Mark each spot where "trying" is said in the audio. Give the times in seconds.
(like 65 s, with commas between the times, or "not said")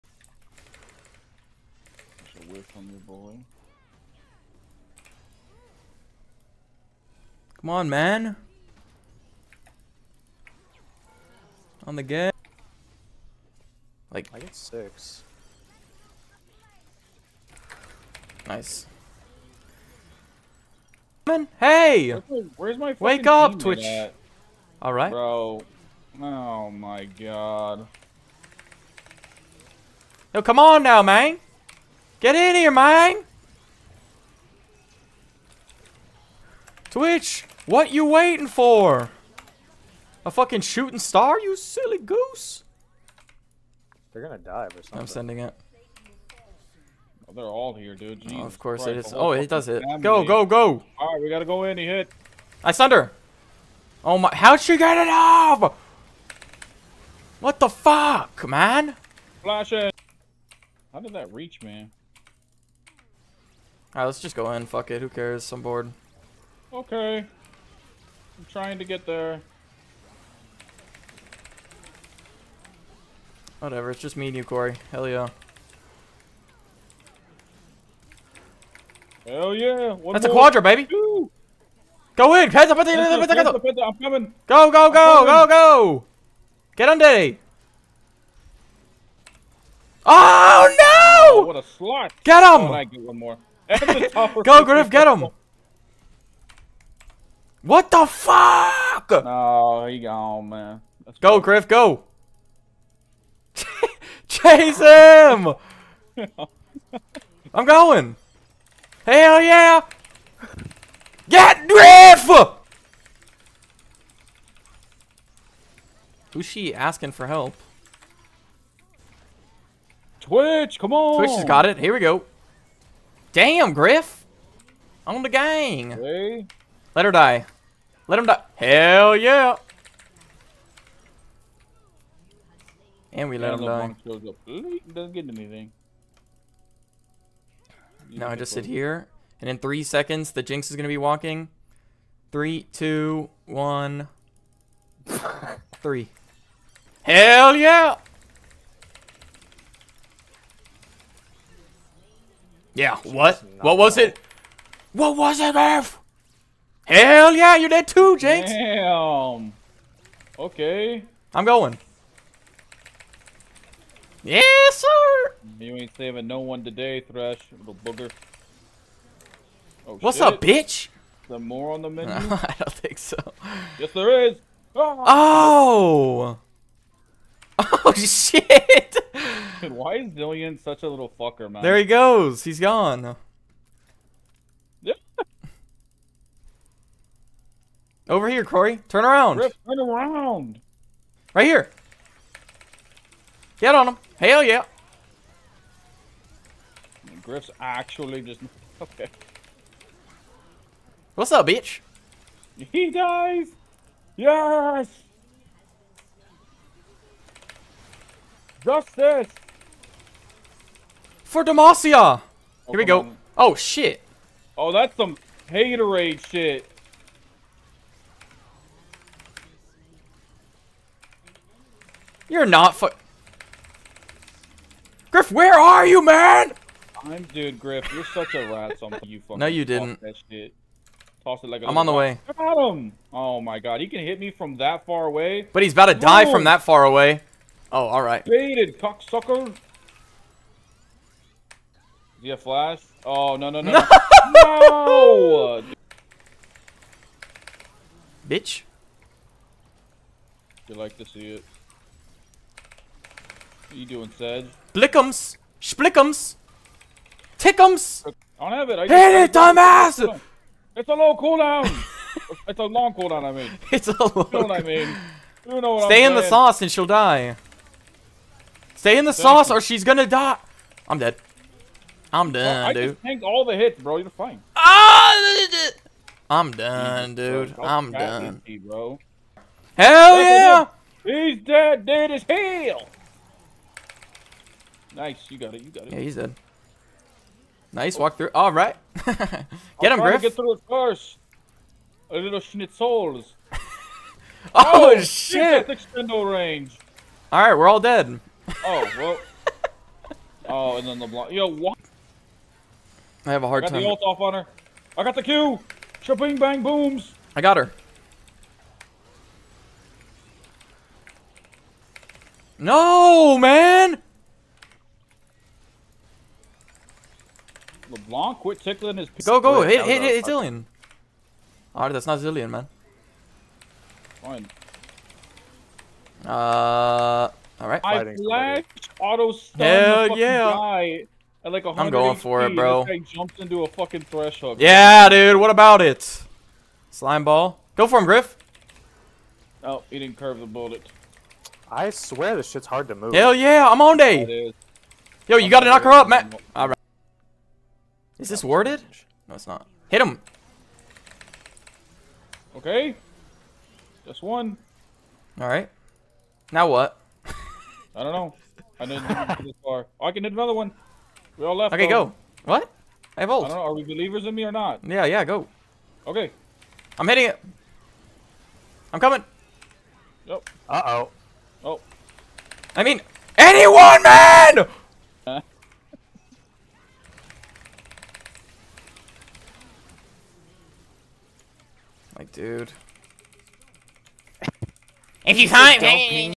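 68 s.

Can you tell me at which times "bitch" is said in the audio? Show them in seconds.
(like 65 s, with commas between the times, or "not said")
170 s, 201 s, 248 s.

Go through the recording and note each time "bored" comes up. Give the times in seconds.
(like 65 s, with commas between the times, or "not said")
65 s.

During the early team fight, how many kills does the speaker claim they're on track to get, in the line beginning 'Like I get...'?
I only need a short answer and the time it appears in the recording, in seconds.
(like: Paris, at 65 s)
6, at 14 s.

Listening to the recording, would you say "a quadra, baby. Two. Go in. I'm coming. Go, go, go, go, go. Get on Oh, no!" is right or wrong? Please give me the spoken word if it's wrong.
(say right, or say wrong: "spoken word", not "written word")
right.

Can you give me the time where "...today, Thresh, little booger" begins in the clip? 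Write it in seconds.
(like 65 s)
166 s.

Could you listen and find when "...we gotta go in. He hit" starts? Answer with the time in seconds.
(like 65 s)
51 s.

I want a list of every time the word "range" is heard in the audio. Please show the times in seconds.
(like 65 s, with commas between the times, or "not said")
296 s.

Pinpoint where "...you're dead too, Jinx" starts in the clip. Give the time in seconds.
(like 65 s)
157 s.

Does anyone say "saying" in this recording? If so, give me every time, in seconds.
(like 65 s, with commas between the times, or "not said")
266 s.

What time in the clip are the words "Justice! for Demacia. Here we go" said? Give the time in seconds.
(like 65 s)
208 s.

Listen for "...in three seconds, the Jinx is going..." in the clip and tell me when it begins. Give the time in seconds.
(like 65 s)
139 s.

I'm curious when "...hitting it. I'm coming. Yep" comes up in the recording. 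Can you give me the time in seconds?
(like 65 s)
367 s.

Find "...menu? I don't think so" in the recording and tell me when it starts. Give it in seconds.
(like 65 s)
171 s.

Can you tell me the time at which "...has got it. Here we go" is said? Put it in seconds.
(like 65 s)
121 s.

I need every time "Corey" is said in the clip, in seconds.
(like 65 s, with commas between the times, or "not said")
74 s, 188 s.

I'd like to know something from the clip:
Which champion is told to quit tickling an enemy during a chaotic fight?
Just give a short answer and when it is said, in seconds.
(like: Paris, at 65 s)
LeBlanc, at 317 s.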